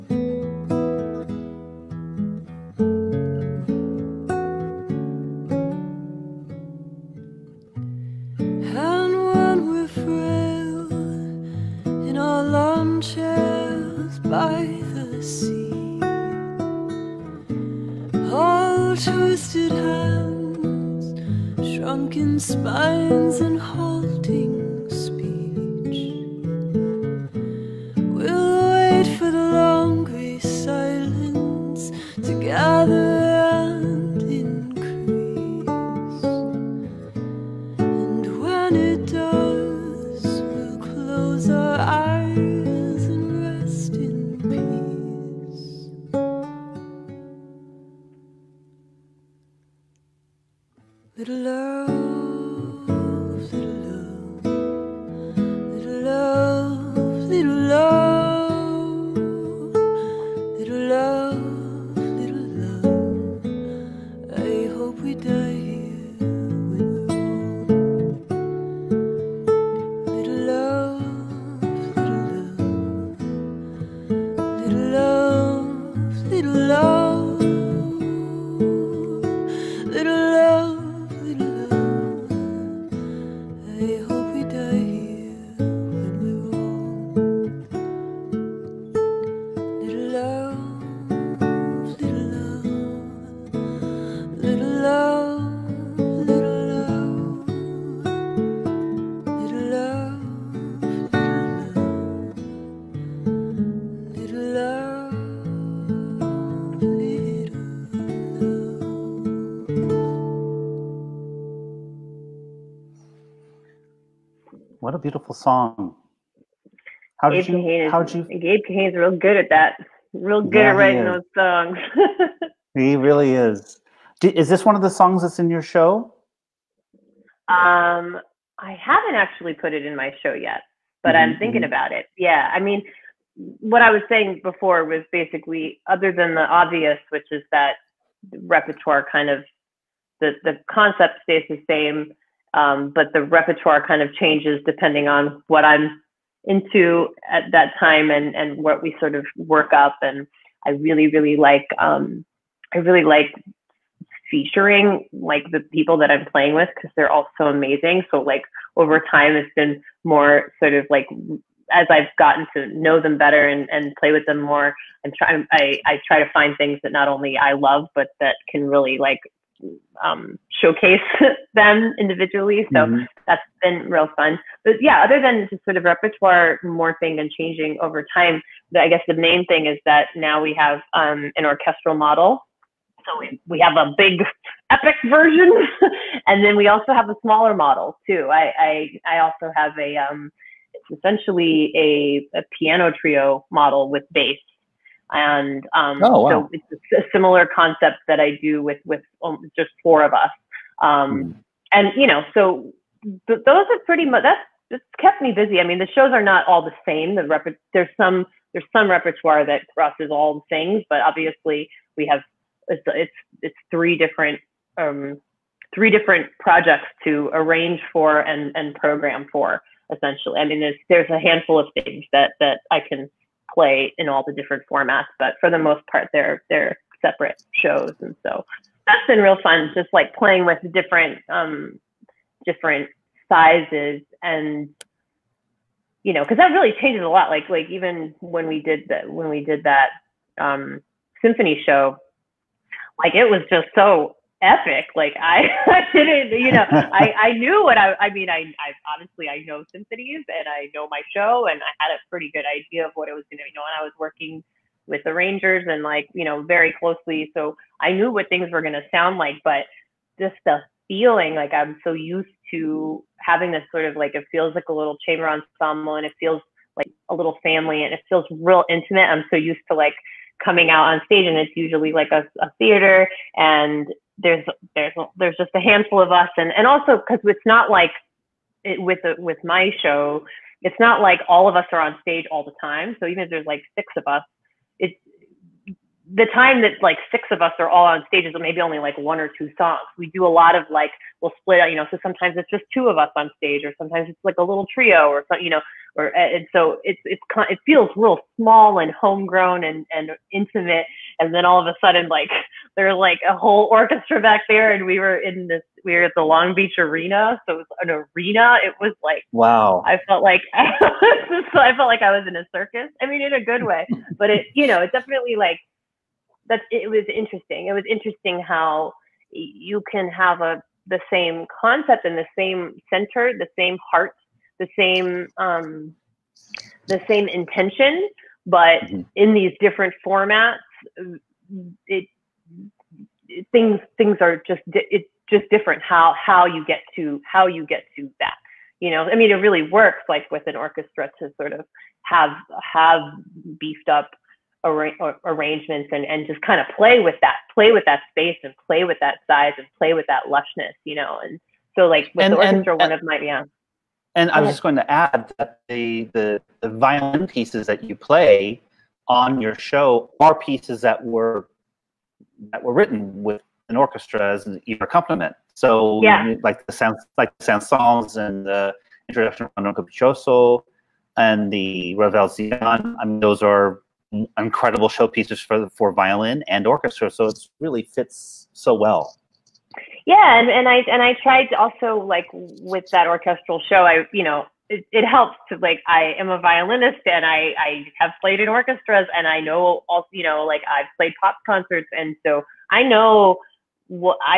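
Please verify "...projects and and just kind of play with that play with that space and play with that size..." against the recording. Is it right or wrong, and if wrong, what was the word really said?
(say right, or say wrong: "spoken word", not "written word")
wrong: "arrangements", not "projects".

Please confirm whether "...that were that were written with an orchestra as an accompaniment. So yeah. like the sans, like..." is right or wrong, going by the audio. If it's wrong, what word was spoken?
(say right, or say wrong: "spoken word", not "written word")
right.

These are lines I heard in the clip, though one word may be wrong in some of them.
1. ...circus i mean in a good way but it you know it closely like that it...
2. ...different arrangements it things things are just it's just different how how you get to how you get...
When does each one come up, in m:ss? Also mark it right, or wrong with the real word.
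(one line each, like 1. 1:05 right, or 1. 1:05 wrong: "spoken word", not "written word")
1. 5:12 wrong: "definitely", not "closely"
2. 5:29 wrong: "formats", not "arrangements".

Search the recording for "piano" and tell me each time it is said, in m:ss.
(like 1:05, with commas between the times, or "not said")
3:12.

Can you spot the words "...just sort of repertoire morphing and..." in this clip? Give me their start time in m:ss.
2:55.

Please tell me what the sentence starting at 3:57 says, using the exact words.
Like like even when we did that when we did that um, symphony show, like it was just so epic.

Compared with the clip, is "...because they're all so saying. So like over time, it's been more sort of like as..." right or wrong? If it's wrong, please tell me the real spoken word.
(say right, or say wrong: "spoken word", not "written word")
wrong: "amazing", not "saying".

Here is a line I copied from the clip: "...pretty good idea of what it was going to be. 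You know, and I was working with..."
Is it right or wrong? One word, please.
right.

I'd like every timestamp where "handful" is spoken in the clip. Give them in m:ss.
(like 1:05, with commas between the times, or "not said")
3:41, 4:35.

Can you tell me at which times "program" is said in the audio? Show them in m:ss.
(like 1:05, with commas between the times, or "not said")
3:38.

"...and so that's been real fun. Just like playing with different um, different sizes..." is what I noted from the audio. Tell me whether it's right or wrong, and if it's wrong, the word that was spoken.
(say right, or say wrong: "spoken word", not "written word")
right.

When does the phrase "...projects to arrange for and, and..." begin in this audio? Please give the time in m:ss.
3:36.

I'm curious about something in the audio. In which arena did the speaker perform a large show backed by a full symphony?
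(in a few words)
Long Beach Arena.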